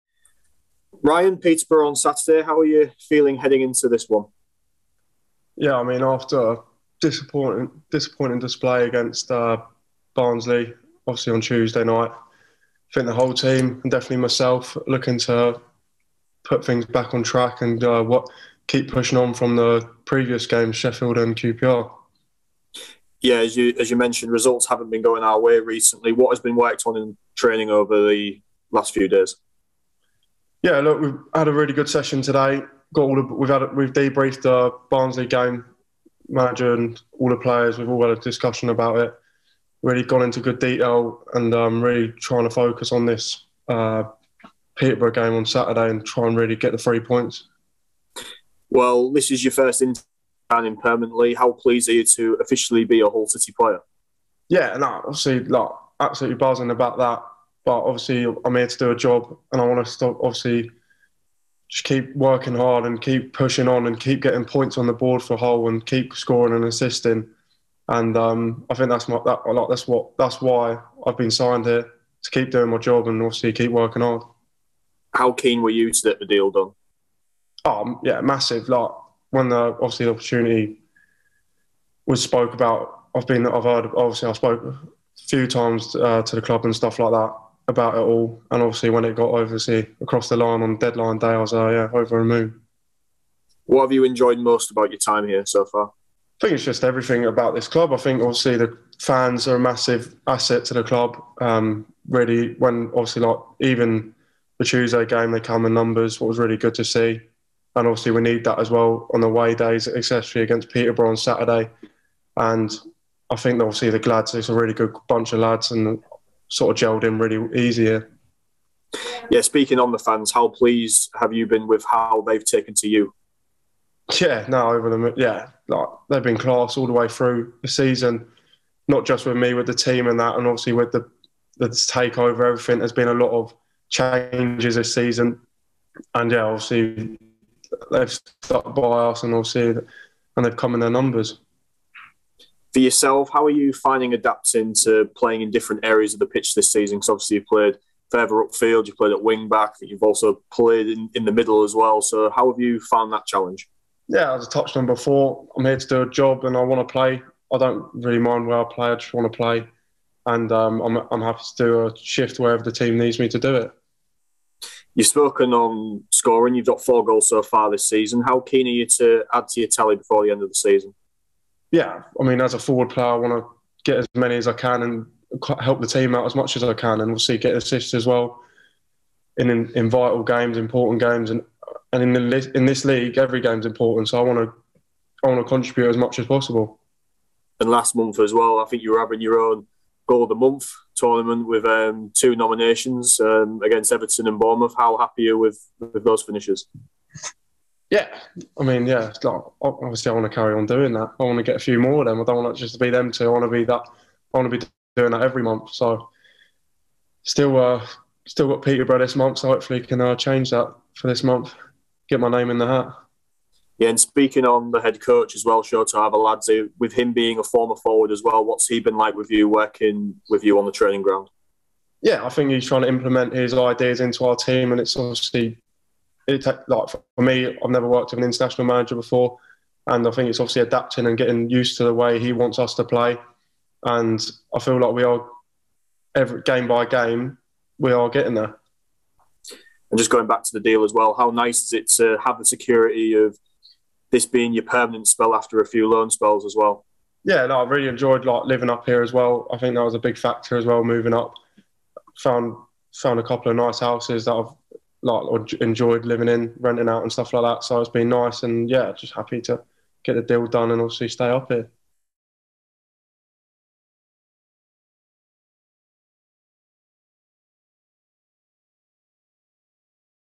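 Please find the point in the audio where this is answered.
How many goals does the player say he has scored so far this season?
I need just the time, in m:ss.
2:46.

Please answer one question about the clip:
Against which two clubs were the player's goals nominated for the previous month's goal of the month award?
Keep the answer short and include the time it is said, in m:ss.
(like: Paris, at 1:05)
Everton and Bournemouth, at 3:13.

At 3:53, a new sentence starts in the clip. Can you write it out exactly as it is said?
And I feel like we are every game by game, we are getting there.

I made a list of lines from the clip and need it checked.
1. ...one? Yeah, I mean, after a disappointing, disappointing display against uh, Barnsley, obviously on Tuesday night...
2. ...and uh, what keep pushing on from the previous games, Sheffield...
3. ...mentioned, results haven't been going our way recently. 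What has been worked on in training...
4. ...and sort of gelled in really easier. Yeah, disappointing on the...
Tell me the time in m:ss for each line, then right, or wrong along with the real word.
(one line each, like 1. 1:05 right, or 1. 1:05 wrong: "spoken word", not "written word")
1. 0:04 right
2. 0:17 right
3. 0:23 right
4. 1:55 wrong: "speaking", not "disappointing".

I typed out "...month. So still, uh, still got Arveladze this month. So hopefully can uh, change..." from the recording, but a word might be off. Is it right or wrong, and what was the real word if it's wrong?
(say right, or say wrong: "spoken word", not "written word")
wrong: "Peterborough", not "Arveladze".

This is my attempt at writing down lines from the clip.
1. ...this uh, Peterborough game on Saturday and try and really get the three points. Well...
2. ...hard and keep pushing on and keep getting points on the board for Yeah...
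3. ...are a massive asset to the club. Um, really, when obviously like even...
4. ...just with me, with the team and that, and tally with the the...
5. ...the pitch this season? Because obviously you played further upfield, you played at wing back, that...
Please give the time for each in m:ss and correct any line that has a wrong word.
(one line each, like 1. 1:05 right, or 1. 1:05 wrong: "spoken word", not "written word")
1. 0:43 right
2. 1:02 wrong: "Hull", not "Yeah"
3. 1:39 right
4. 2:09 wrong: "obviously", not "tally"
5. 2:26 right.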